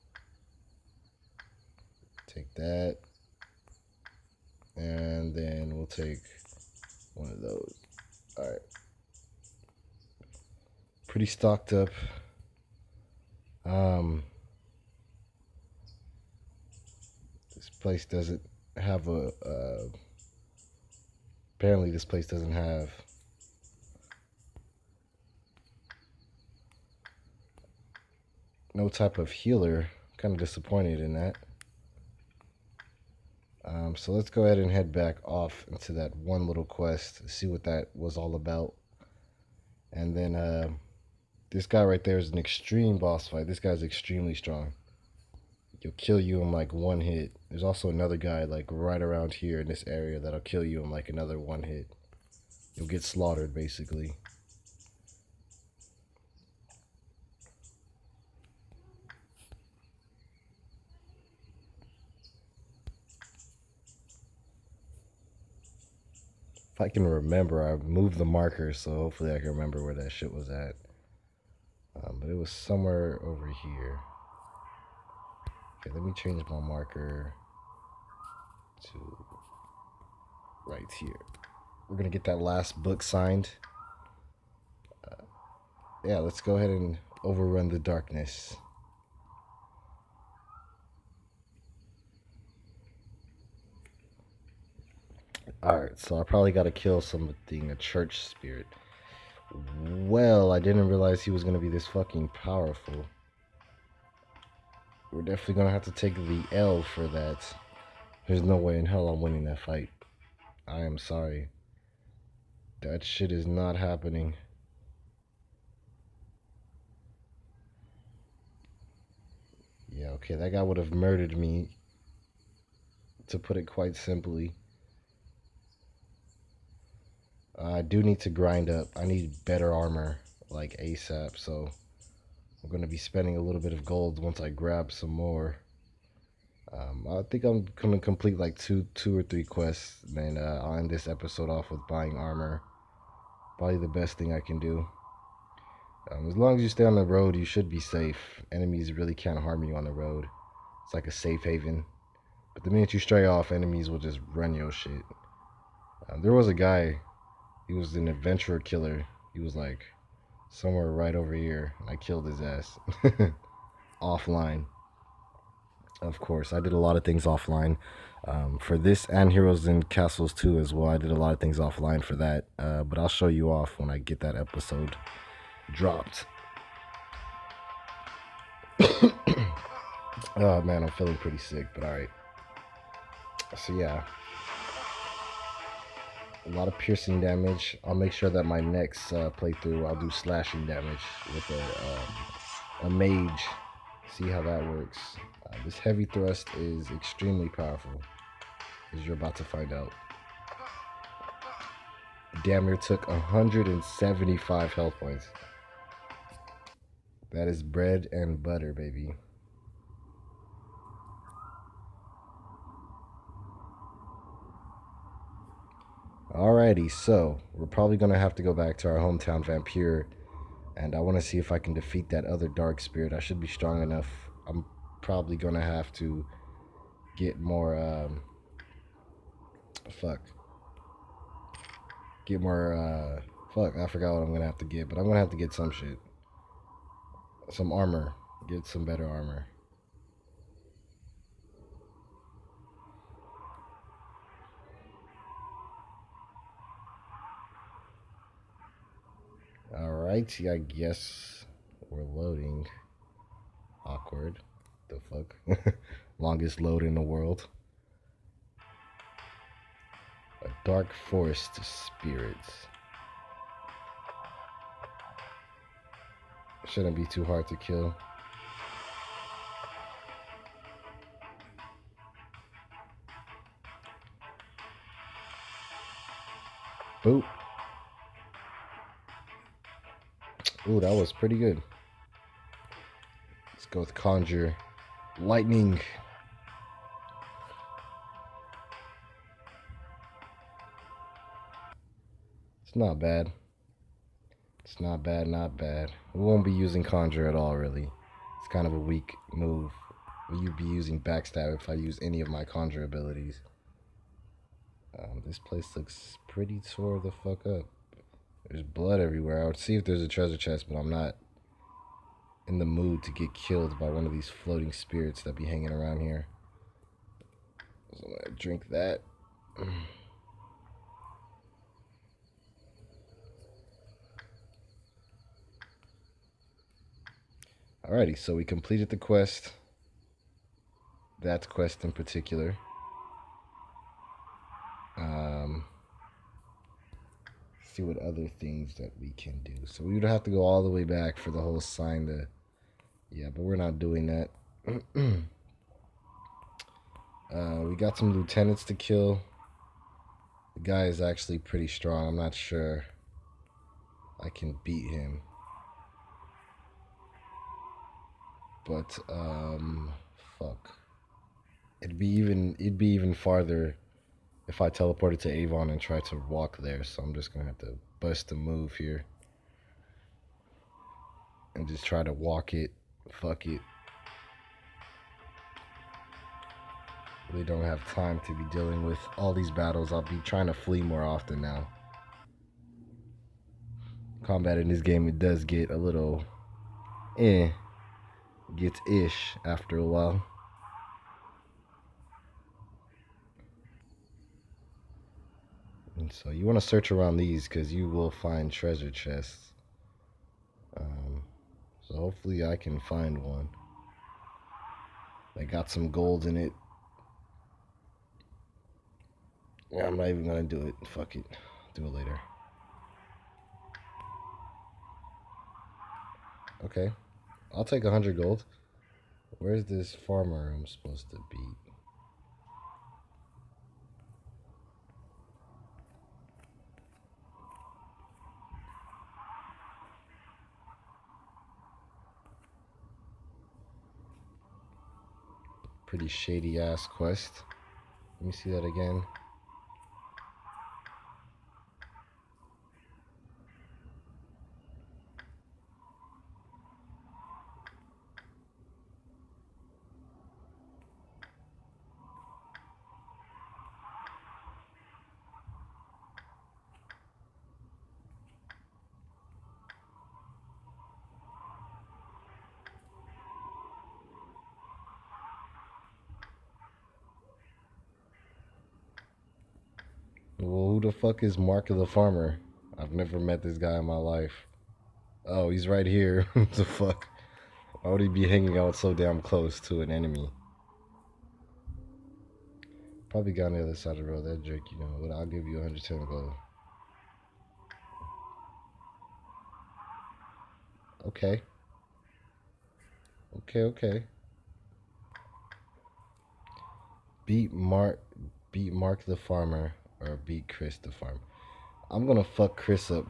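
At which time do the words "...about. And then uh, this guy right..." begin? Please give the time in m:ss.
0:38.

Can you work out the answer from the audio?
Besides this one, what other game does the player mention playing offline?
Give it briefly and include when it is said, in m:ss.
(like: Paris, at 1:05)
Heroes and Castles 2, at 2:49.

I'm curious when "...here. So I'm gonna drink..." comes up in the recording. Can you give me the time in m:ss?
5:16.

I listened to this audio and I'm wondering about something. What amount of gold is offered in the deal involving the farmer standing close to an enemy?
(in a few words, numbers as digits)
110 gold.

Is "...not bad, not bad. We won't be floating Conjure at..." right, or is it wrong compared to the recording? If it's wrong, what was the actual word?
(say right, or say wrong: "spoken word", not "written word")
wrong: "using", not "floating".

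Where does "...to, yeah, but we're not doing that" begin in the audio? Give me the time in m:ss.
5:42.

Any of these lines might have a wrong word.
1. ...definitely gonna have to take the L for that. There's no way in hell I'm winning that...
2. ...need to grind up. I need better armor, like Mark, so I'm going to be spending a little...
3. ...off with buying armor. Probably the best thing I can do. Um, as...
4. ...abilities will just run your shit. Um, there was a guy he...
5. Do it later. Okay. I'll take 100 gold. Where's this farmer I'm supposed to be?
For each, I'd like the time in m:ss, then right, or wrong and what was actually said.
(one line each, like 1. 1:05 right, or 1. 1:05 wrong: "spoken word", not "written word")
1. 1:45 right
2. 2:08 wrong: "ASAP", not "Mark"
3. 2:21 right
4. 2:33 wrong: "enemies", not "abilities"
5. 6:51 right.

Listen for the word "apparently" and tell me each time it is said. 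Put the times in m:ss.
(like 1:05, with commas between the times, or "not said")
0:21.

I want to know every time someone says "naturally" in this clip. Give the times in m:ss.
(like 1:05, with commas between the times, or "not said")
not said.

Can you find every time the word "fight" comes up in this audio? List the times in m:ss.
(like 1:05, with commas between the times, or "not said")
0:43, 1:49.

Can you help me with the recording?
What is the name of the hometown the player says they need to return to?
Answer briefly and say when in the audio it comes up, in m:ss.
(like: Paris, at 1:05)
Vampire, at 3:39.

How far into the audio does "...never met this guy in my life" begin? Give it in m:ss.
7:52.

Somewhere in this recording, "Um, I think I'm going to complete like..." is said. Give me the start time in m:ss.
2:16.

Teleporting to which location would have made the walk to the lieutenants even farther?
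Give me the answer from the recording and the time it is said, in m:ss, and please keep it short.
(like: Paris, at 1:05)
Avon, at 6:05.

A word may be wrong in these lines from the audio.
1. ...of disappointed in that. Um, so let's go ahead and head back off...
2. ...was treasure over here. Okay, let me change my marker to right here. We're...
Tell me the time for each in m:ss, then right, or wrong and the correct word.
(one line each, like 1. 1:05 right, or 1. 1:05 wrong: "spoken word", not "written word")
1. 0:30 right
2. 1:12 wrong: "somewhere", not "treasure".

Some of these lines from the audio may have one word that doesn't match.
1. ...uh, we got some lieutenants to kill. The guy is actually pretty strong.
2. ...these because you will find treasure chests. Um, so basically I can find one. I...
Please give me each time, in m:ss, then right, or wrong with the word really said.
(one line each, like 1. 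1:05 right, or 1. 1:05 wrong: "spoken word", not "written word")
1. 5:47 right
2. 6:37 wrong: "hopefully", not "basically".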